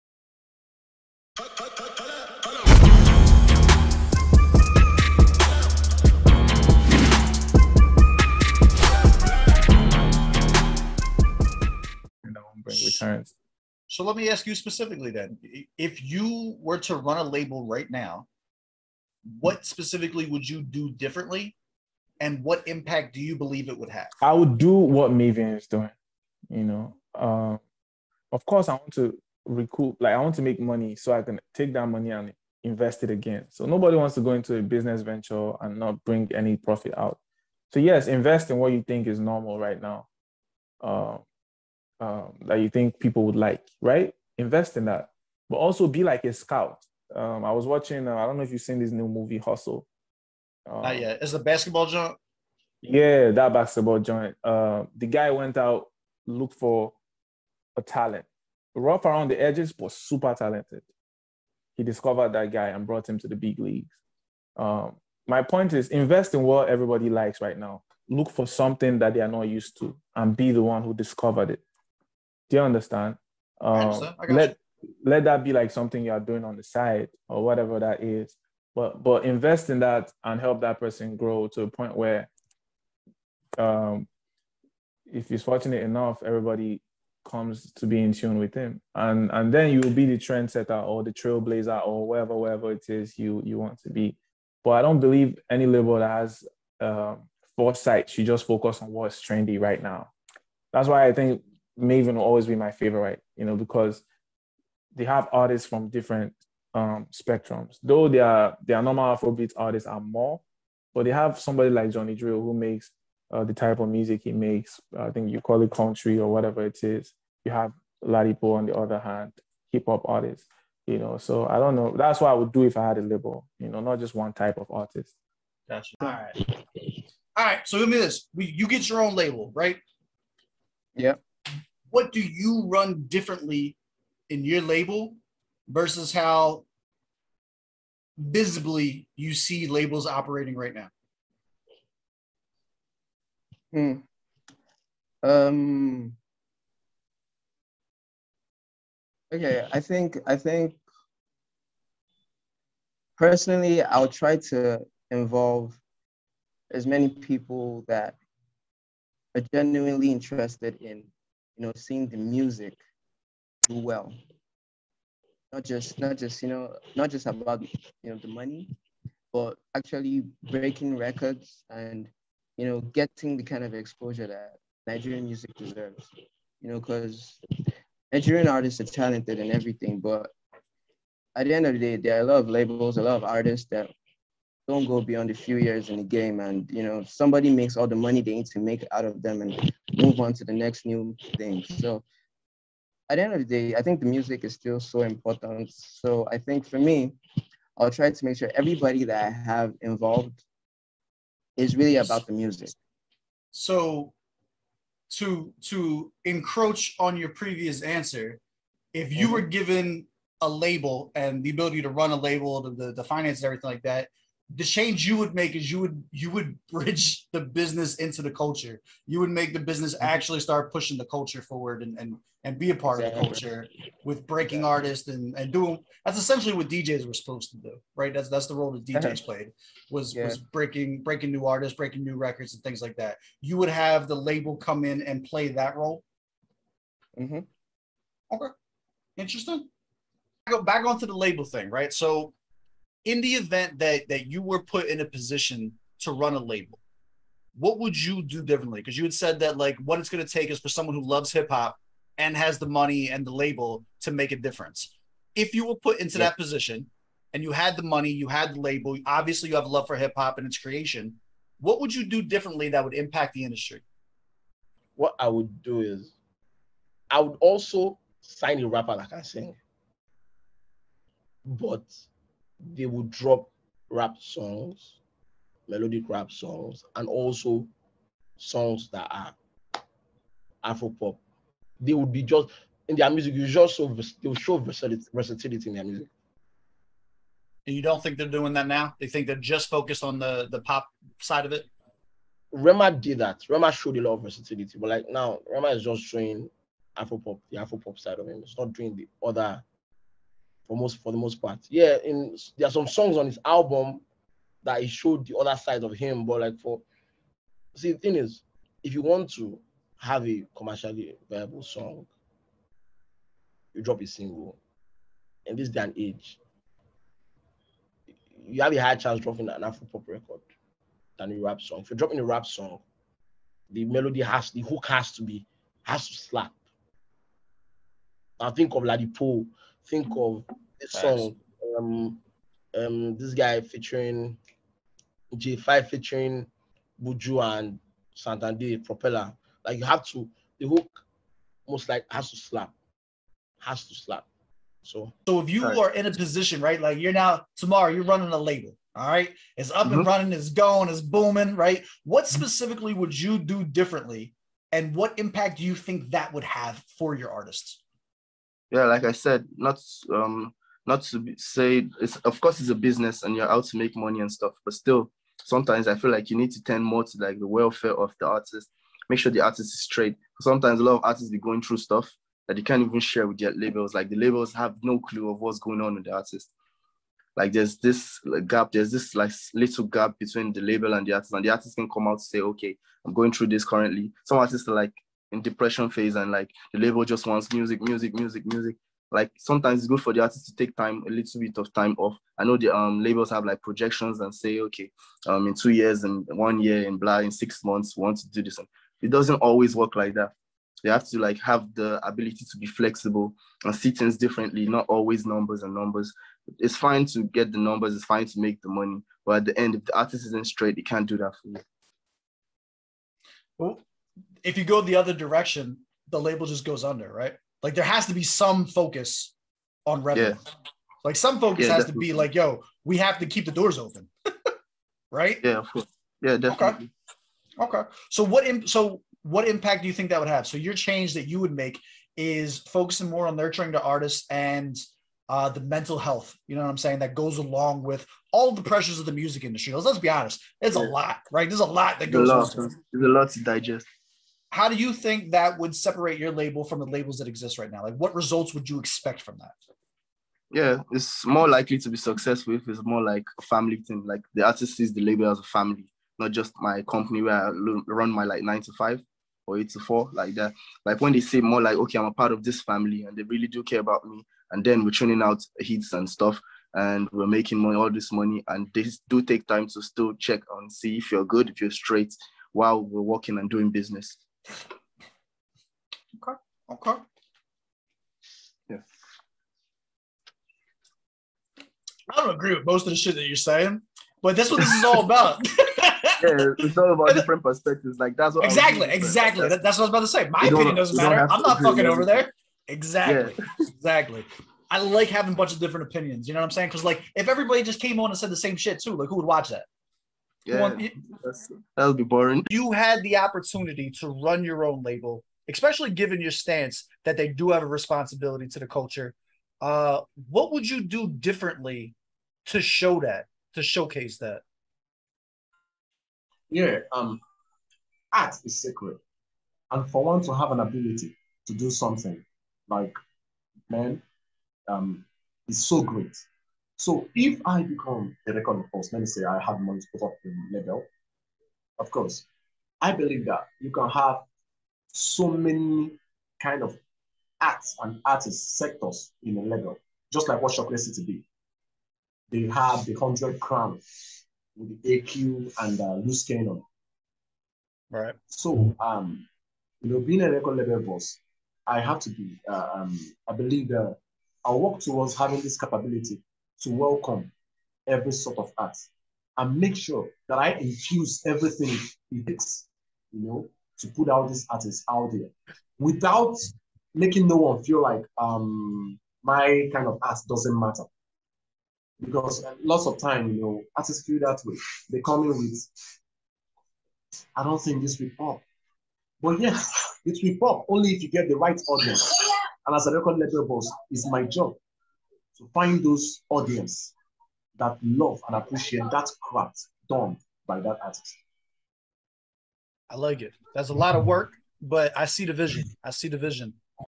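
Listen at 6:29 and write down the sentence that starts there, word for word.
Like sometimes it's good for the artist to take time, a little bit of time off.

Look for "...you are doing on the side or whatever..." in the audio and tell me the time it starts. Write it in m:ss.
1:16.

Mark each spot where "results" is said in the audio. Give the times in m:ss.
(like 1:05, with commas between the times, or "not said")
7:28.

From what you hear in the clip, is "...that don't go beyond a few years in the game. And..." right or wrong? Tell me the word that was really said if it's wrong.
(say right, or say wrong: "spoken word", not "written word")
right.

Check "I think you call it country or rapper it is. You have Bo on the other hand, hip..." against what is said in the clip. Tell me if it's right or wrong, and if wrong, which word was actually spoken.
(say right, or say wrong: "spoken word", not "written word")
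wrong: "whatever", not "rapper".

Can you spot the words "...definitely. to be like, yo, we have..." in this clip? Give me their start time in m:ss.
7:01.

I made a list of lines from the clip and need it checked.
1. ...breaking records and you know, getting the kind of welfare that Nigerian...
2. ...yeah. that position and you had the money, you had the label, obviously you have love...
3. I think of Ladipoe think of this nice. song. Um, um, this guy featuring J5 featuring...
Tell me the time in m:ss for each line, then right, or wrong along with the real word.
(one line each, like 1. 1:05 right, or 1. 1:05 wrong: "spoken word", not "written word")
1. 2:50 wrong: "exposure", not "welfare"
2. 4:16 right
3. 5:28 right.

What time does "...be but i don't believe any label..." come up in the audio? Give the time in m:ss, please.
1:33.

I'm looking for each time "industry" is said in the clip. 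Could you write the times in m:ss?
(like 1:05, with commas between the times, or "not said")
4:23, 7:19.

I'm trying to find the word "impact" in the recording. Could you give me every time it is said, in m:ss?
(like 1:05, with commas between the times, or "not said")
0:22, 4:22, 5:55, 7:09.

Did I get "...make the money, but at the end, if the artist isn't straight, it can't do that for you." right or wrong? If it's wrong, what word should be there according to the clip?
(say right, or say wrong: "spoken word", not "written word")
right.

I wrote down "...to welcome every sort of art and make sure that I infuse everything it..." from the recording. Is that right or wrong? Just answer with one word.
right.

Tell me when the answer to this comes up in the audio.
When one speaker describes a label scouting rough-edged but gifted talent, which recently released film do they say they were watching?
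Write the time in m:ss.
0:49.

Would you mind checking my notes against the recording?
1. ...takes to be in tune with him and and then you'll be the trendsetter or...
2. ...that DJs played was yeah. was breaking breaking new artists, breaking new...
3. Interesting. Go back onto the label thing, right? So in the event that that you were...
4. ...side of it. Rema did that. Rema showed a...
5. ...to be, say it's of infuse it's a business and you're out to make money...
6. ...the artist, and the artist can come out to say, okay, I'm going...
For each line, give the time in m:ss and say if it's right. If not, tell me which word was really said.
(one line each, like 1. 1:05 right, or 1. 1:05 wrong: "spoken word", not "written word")
1. 1:27 wrong: "comes", not "takes"
2. 3:48 right
3. 3:59 right
4. 4:51 right
5. 6:01 wrong: "course", not "infuse"
6. 6:21 right.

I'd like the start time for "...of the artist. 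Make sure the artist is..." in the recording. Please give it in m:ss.
6:07.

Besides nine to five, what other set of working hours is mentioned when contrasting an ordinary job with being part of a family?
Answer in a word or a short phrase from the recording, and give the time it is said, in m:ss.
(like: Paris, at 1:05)
eight to four, at 7:39.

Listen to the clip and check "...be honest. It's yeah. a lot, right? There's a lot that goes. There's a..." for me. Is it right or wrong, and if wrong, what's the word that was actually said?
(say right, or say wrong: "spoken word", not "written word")
right.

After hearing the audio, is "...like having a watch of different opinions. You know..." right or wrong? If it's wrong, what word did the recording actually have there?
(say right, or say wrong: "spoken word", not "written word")
wrong: "bunch", not "watch".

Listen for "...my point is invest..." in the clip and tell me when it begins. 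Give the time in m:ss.
1:05.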